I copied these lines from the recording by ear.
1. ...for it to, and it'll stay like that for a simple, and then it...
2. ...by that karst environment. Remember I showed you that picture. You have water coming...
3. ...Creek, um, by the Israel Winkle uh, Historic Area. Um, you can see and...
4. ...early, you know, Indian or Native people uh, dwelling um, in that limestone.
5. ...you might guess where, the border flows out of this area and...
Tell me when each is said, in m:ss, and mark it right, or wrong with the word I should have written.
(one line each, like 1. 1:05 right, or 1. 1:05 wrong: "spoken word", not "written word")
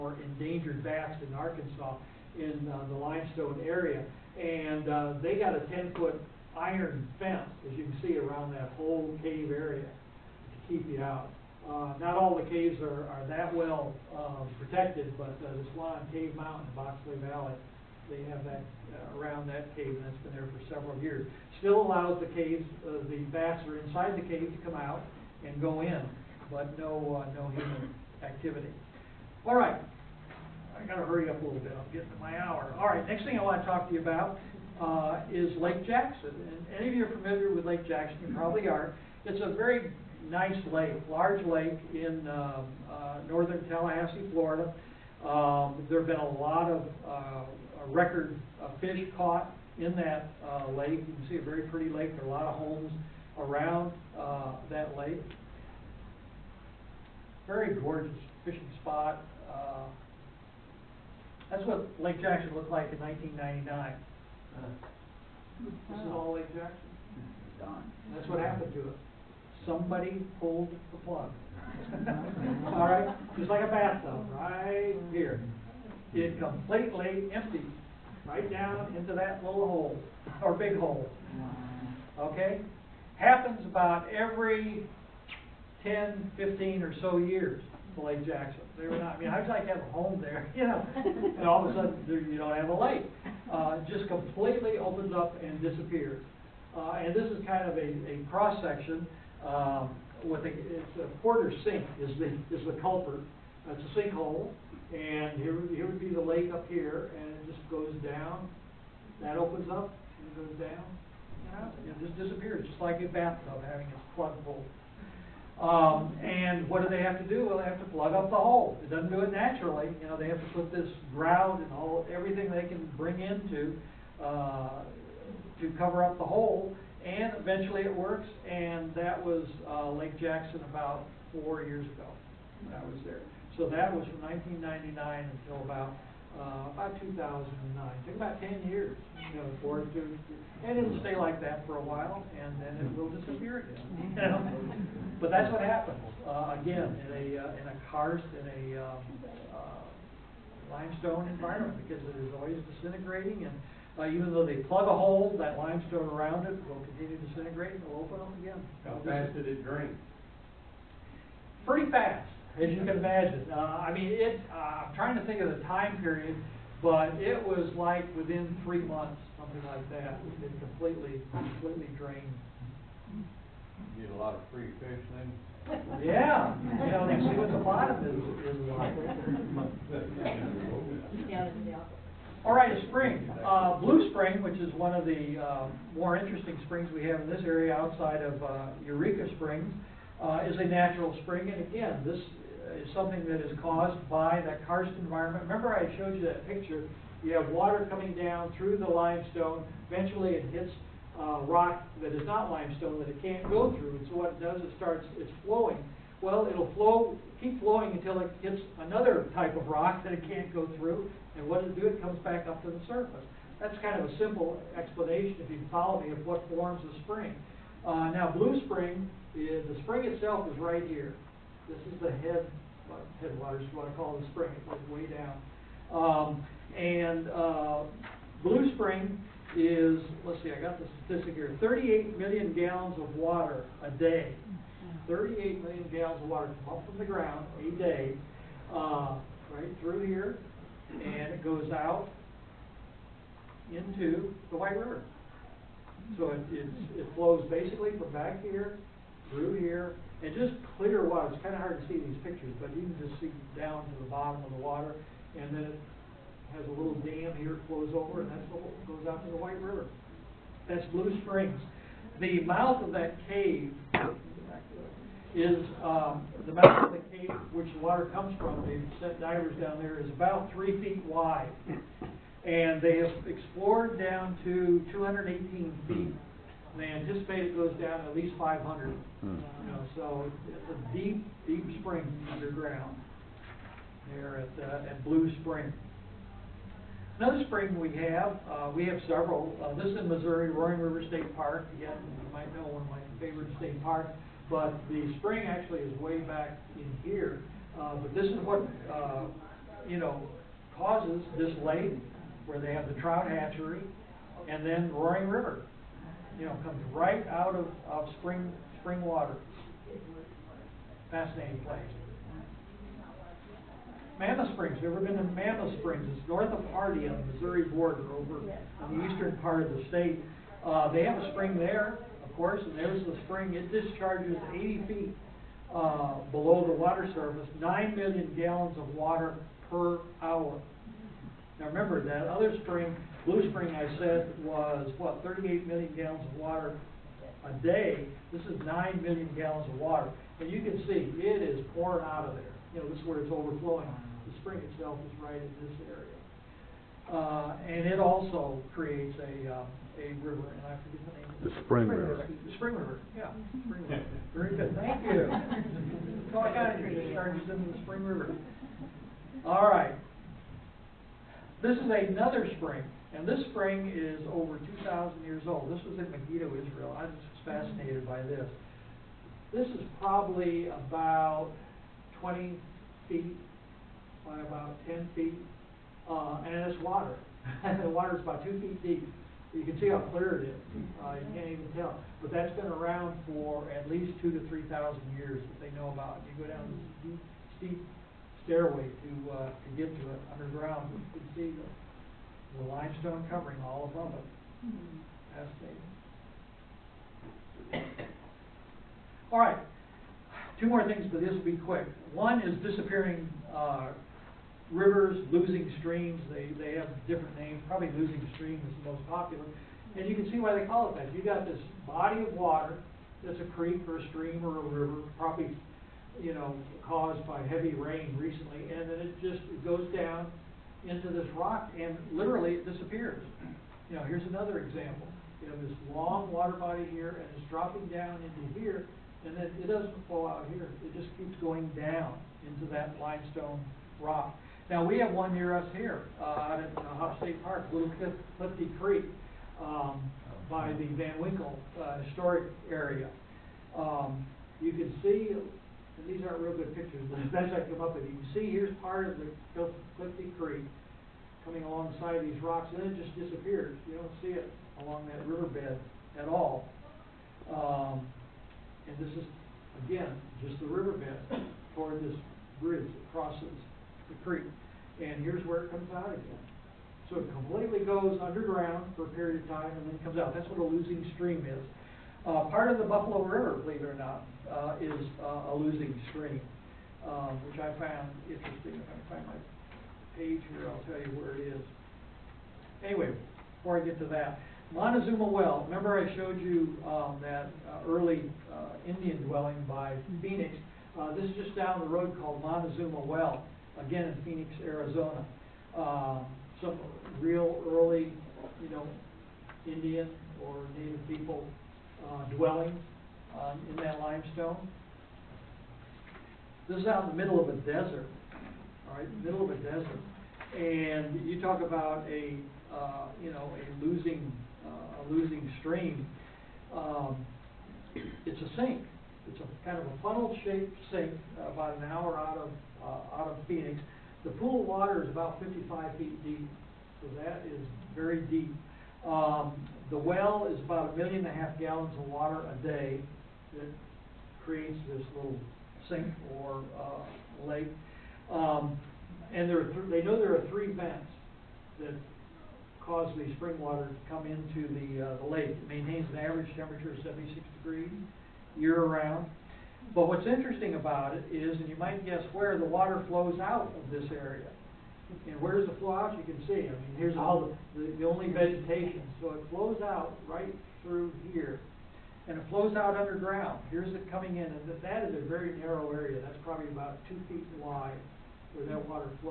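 1. 2:19 wrong: "while", not "simple"
2. 3:14 right
3. 7:18 wrong: "Van", not "Israel"
4. 8:17 right
5. 9:11 wrong: "water", not "border".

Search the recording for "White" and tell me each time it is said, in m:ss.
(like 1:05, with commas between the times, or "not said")
4:04, 4:19.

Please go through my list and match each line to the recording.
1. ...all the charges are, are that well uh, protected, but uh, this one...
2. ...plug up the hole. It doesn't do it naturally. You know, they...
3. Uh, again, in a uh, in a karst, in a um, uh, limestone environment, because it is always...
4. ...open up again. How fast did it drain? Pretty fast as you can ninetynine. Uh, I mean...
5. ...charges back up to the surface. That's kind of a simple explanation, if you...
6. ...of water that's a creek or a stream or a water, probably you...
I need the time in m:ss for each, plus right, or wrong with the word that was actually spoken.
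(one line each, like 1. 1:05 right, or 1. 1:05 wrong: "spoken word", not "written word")
1. 0:12 wrong: "caves", not "charges"
2. 1:57 right
3. 2:26 right
4. 2:38 wrong: "imagine", not "ninetynine"
5. 3:32 wrong: "comes", not "charges"
6. 6:52 wrong: "river", not "water".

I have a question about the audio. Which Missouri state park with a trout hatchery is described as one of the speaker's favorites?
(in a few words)
Roaring River State Park.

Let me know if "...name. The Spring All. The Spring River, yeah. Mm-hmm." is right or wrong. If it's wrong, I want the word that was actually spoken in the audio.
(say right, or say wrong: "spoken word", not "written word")
wrong: "River", not "All".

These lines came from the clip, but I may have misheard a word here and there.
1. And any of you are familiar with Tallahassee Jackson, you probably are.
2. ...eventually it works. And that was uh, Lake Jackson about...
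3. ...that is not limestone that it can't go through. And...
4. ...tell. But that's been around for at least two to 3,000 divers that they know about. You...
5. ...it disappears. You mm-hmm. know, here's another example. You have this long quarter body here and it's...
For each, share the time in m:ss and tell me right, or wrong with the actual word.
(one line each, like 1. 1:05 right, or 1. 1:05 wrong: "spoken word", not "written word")
1. 0:36 wrong: "Lake", not "Tallahassee"
2. 2:07 right
3. 3:22 right
4. 6:21 wrong: "years", not "divers"
5. 7:02 wrong: "water", not "quarter".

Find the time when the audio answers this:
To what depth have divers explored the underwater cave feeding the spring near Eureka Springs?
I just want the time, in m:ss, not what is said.
4:34.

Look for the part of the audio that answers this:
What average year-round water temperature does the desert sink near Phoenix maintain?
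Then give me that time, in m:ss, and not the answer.
9:07.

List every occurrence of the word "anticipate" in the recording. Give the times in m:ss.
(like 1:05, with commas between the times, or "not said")
4:36.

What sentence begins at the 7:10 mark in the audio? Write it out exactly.
It just keeps going down into that limestone rock.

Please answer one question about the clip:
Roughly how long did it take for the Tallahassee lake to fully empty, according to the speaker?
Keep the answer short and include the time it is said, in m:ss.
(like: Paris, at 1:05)
3 months, at 2:48.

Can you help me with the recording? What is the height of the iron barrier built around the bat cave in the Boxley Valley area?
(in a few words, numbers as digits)
10-foot.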